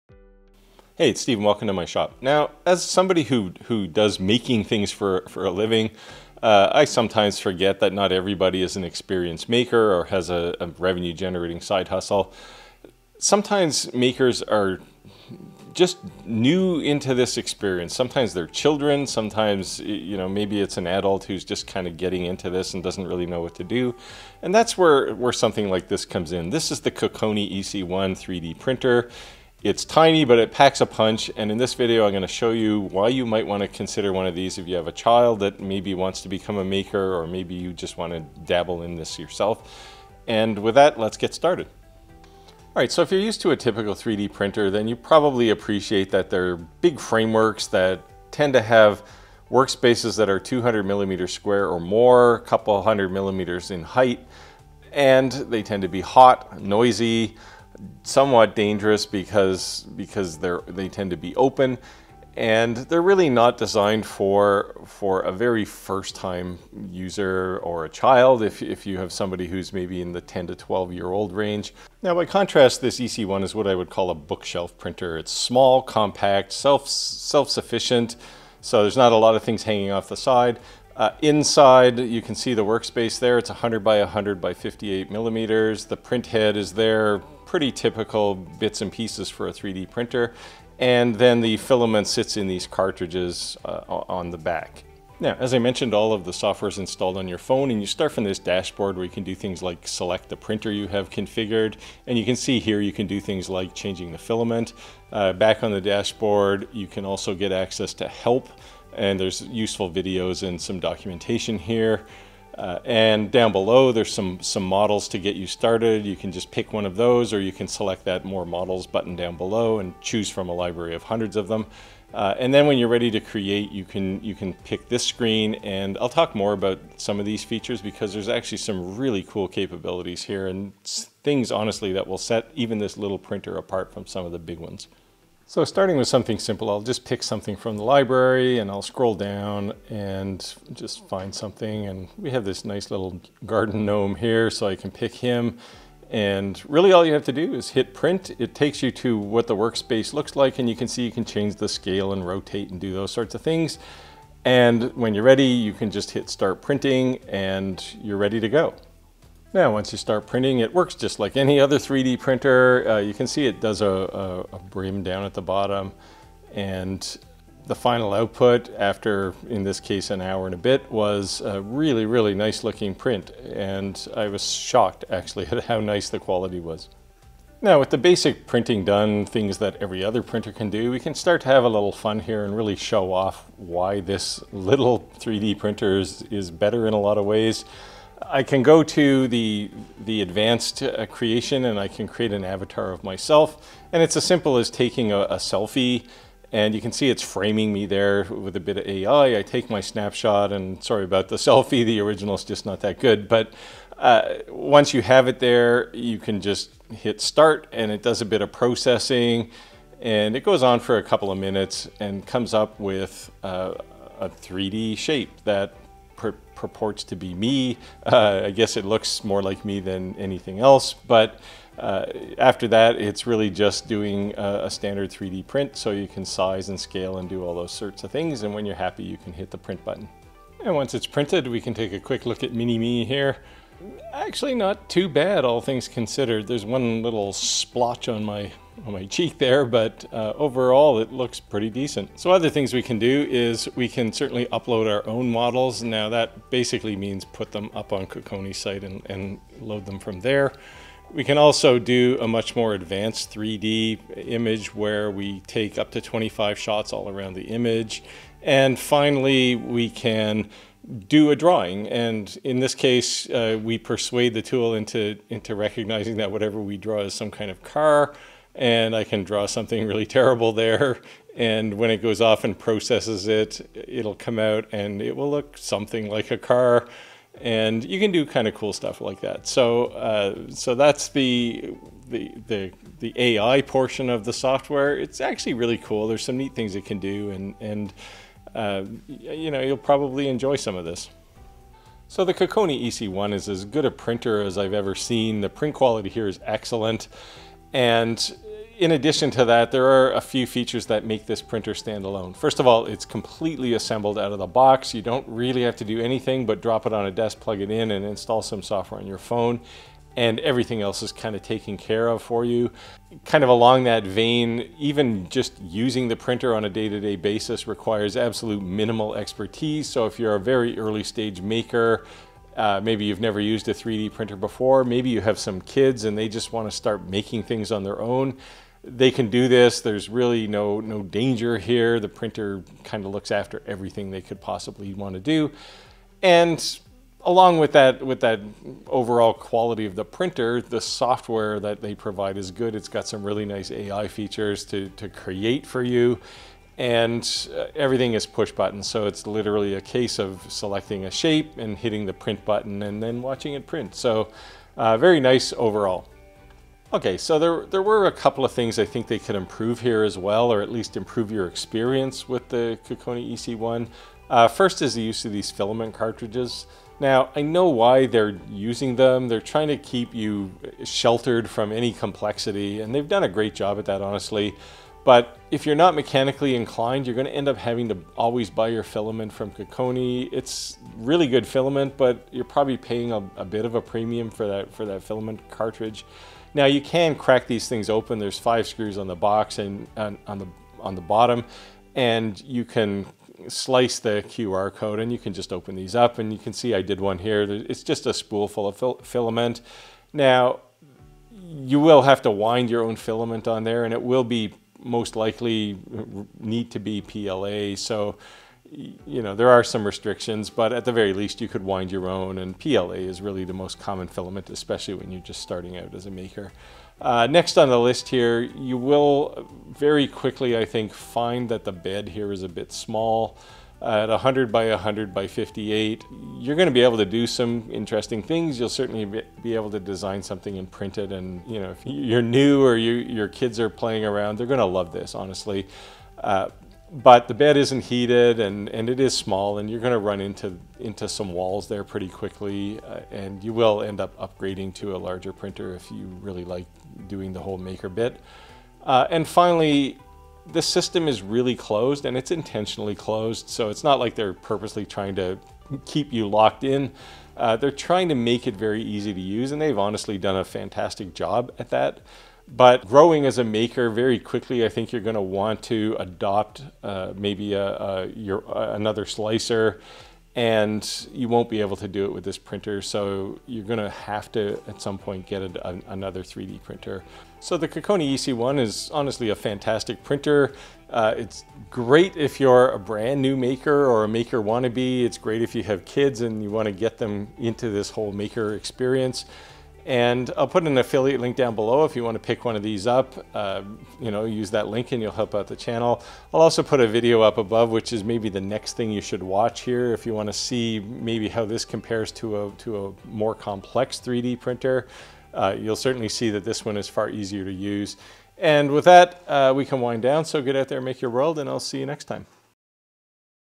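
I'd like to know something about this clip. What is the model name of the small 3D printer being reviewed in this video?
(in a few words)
Kokoni EC1.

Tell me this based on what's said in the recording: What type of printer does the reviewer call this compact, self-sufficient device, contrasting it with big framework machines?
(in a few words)
bookshelf printer.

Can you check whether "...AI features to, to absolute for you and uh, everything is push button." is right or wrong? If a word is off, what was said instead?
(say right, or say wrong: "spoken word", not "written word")
wrong: "create", not "absolute".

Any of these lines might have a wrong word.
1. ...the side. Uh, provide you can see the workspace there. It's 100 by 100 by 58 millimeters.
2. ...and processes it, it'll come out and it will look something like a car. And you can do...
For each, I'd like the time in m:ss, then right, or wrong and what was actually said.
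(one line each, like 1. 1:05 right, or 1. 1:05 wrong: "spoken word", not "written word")
1. 1:20 wrong: "inside", not "provide"
2. 4:32 right.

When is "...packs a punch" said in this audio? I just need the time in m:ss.
0:30.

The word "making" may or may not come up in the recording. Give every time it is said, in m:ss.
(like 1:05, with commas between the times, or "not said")
0:04, 5:27.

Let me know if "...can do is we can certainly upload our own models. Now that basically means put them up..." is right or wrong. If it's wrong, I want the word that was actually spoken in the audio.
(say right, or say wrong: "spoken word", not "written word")
right.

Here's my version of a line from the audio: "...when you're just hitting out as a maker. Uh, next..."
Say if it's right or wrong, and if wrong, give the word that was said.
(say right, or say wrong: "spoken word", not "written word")
wrong: "starting", not "hitting".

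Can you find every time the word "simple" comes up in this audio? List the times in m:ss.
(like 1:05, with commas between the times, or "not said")
2:16, 3:14.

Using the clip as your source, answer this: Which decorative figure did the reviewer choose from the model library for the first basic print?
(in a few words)
garden gnome.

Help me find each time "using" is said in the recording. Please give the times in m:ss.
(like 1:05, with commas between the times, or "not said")
5:15, 6:08.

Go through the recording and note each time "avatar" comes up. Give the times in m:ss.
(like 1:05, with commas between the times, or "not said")
3:12.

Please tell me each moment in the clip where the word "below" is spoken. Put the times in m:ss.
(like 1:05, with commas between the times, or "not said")
1:53, 1:59, 8:11.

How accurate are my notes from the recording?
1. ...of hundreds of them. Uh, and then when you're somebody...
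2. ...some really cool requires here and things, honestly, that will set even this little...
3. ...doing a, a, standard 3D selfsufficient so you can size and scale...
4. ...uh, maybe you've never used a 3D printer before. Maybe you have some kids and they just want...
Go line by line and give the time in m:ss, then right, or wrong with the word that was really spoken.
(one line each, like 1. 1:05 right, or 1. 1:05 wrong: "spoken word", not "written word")
1. 2:00 wrong: "ready", not "somebody"
2. 2:08 wrong: "capabilities", not "requires"
3. 3:43 wrong: "print", not "selfsufficient"
4. 5:22 right.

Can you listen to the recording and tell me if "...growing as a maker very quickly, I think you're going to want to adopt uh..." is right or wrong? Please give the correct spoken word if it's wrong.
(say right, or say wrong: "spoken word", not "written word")
right.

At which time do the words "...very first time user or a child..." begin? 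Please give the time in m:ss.
1:05.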